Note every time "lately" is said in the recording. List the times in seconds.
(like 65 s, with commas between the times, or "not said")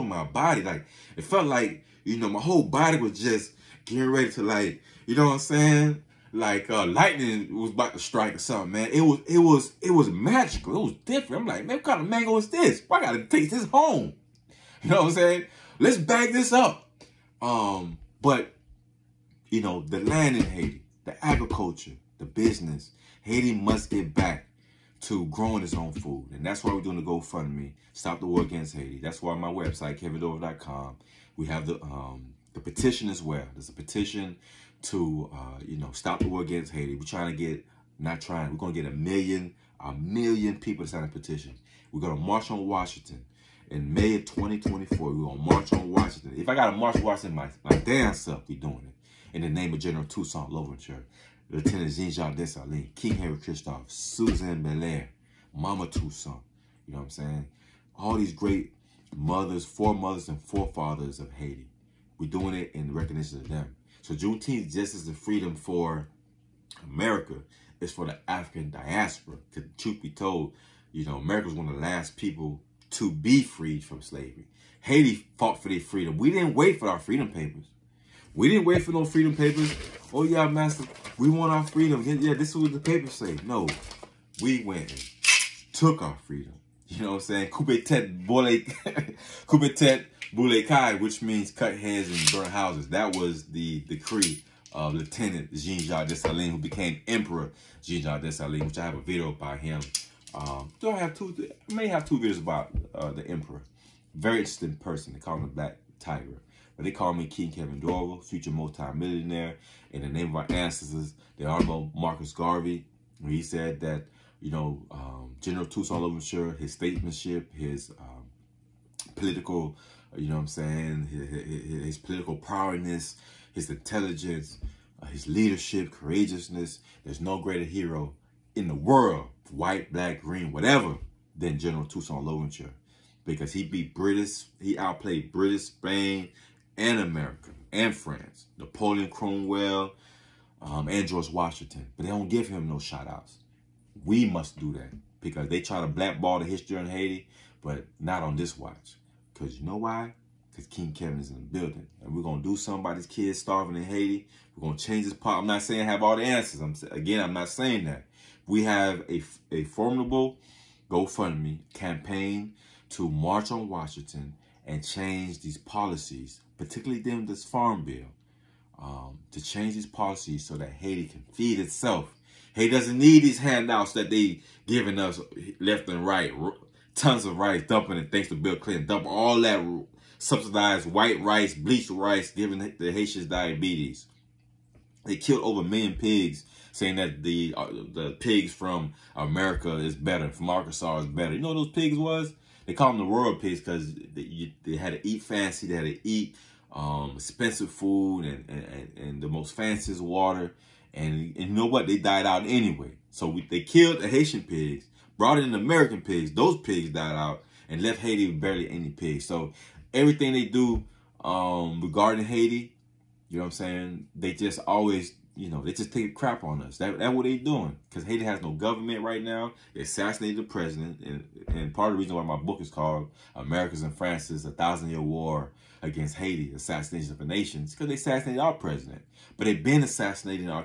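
not said.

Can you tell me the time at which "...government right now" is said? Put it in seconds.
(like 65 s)
218 s.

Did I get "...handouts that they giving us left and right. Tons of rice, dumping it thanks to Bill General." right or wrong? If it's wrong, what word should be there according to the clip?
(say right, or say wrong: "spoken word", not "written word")
wrong: "Clinton", not "General".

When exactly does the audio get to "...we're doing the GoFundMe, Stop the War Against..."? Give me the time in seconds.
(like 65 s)
26 s.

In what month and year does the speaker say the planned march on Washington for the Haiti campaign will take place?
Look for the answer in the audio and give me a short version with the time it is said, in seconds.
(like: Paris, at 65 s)
May 2024, at 43 s.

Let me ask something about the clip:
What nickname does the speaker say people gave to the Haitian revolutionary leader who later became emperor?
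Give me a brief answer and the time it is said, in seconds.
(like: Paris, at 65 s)
the Black Tiger, at 105 s.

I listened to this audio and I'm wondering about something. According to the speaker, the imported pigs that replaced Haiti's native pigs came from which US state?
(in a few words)
Arkansas.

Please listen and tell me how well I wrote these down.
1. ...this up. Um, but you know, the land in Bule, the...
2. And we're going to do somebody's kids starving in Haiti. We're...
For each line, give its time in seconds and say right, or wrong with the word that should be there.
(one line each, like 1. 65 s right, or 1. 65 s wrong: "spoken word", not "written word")
1. 16 s wrong: "Haiti", not "Bule"
2. 152 s right.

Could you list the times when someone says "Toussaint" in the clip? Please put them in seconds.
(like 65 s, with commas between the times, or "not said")
50 s, 55 s, 131 s.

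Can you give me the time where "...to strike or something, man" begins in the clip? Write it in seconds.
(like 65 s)
7 s.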